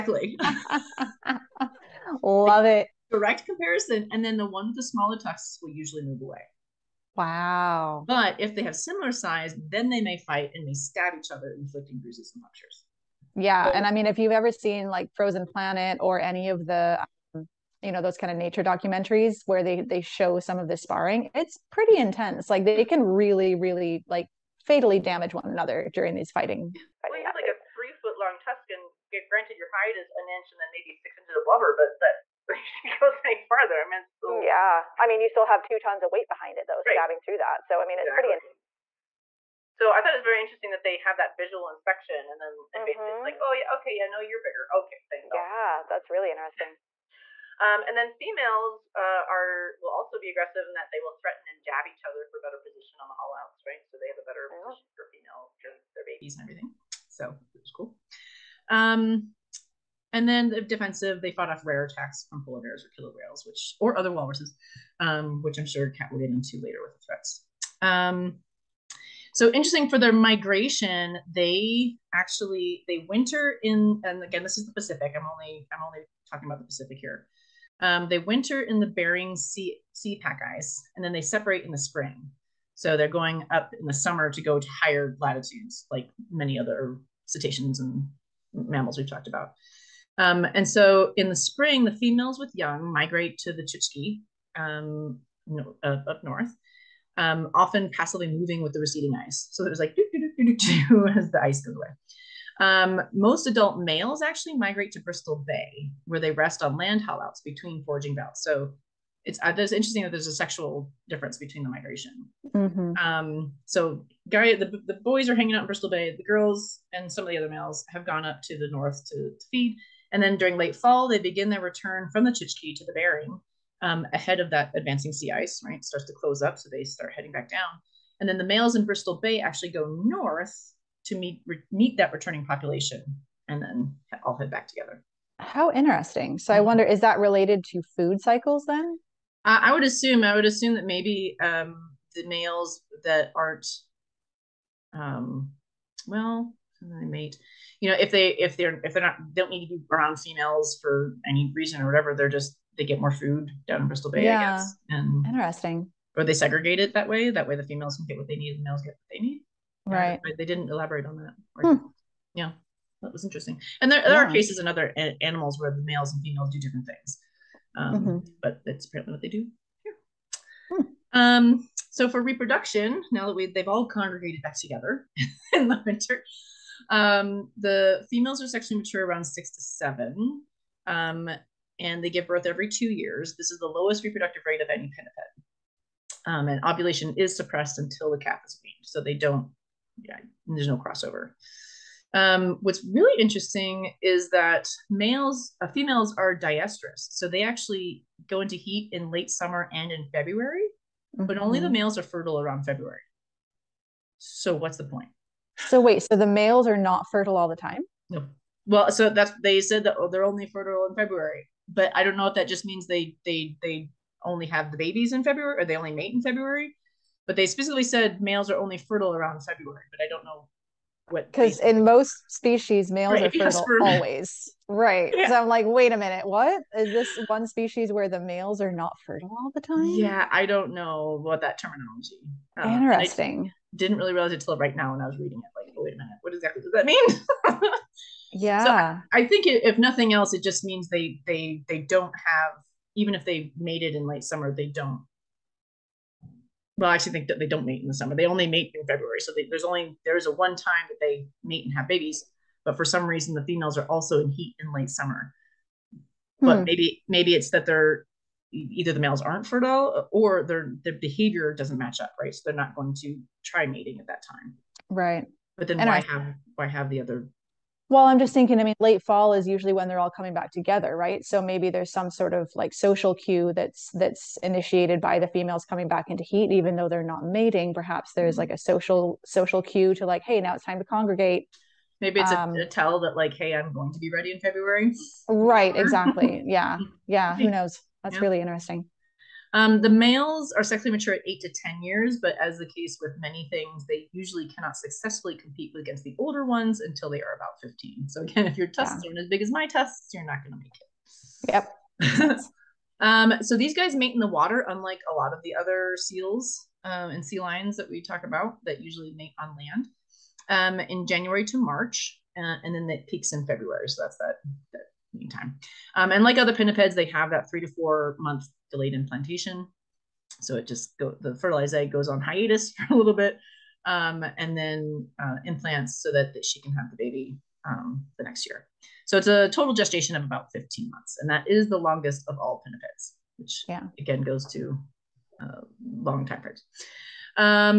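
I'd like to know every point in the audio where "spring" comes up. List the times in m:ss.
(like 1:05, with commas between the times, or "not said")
1:21, 1:31.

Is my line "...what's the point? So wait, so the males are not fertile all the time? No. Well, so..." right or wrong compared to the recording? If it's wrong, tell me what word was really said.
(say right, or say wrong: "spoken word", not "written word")
right.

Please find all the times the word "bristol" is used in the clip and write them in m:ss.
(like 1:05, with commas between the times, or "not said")
1:45, 1:55, 2:08, 2:33.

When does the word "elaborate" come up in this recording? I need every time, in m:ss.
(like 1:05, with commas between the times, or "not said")
2:40.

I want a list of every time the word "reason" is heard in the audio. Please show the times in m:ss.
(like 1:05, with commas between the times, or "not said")
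2:31, 4:13.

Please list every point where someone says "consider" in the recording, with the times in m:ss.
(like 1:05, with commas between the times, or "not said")
not said.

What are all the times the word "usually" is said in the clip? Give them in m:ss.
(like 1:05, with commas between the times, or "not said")
0:05, 4:29, 4:54, 5:08.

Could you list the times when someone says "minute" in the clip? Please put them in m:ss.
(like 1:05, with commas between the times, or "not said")
3:45, 3:55.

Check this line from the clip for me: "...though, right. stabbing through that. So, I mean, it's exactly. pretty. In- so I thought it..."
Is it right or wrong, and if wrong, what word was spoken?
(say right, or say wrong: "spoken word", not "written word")
right.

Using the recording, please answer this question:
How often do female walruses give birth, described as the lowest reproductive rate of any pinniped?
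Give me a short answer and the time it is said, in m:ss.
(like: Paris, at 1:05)
every 2 years, at 3:02.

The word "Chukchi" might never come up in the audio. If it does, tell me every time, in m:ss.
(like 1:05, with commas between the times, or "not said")
1:33, 2:02.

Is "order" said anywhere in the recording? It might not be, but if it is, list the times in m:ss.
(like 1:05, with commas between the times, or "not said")
not said.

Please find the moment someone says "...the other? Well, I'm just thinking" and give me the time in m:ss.
4:26.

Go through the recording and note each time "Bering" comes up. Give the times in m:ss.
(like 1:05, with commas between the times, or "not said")
1:18, 2:02.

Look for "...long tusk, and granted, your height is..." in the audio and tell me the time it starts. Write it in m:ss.
0:28.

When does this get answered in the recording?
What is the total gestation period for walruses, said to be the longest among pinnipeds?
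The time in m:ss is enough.
5:30.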